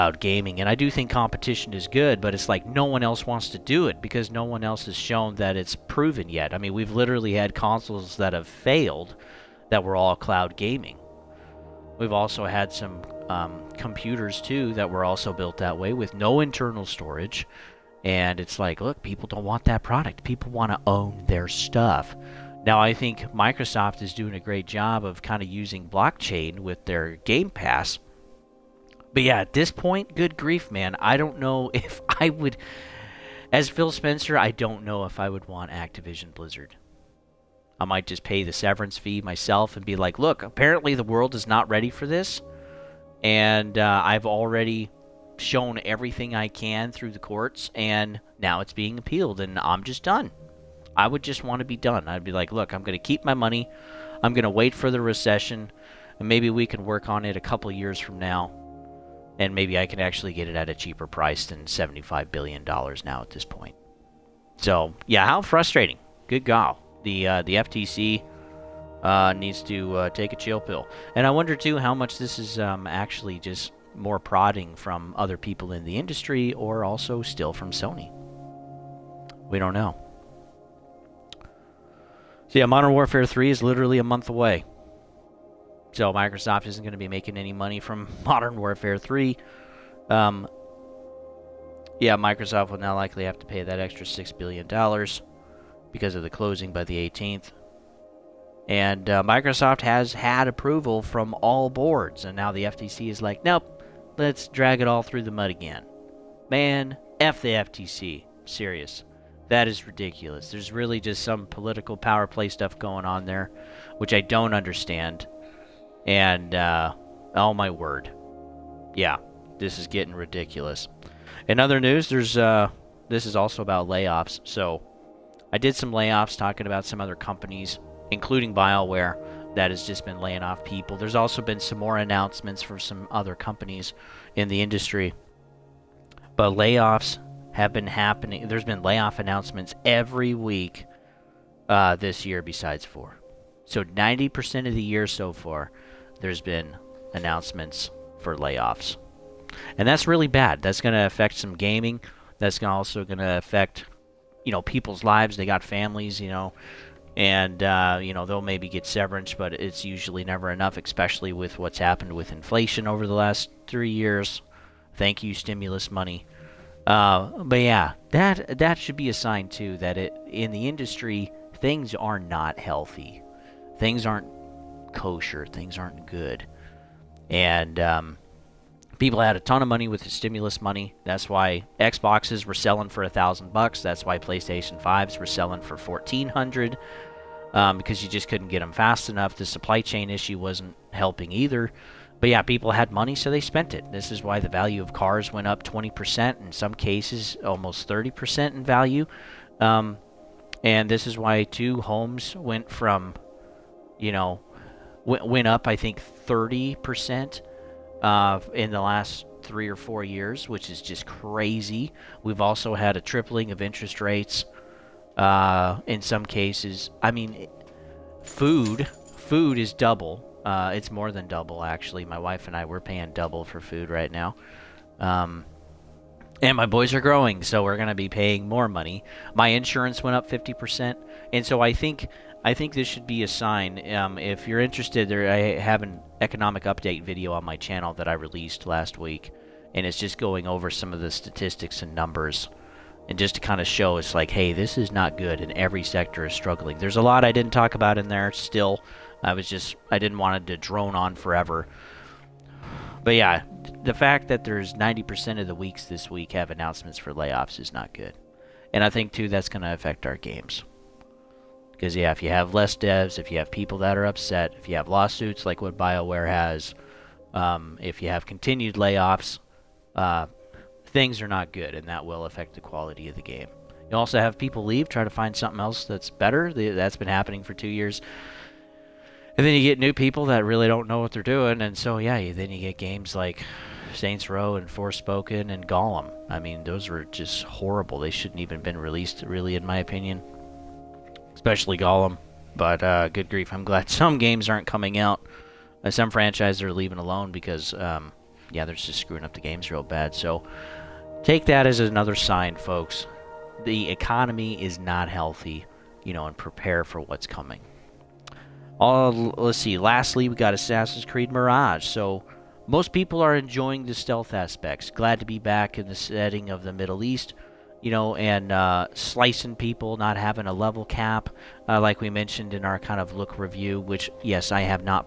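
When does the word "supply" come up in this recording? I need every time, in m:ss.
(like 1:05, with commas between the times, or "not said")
3:09.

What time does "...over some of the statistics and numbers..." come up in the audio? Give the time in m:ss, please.
4:00.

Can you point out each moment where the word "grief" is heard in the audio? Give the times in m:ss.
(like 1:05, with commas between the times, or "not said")
0:30, 4:53.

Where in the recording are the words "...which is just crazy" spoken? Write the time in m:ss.
3:30.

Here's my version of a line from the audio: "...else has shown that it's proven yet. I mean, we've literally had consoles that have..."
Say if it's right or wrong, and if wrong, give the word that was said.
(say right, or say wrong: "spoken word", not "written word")
right.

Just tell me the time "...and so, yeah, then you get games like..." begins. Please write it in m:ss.
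4:41.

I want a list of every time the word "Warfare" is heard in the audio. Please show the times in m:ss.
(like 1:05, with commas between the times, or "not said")
1:22, 1:28.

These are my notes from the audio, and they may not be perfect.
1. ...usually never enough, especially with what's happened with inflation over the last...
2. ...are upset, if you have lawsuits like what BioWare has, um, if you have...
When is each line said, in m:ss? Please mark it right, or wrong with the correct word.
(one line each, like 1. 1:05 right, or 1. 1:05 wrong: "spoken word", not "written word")
1. 2:39 right
2. 4:23 right.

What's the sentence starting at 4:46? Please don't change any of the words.
I mean, those were just horrible.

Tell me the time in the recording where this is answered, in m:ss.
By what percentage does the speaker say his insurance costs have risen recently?
3:50.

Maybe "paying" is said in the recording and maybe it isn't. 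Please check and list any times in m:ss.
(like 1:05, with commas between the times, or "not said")
3:42, 3:48.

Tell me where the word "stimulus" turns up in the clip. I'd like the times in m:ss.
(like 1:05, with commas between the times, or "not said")
2:45, 3:00.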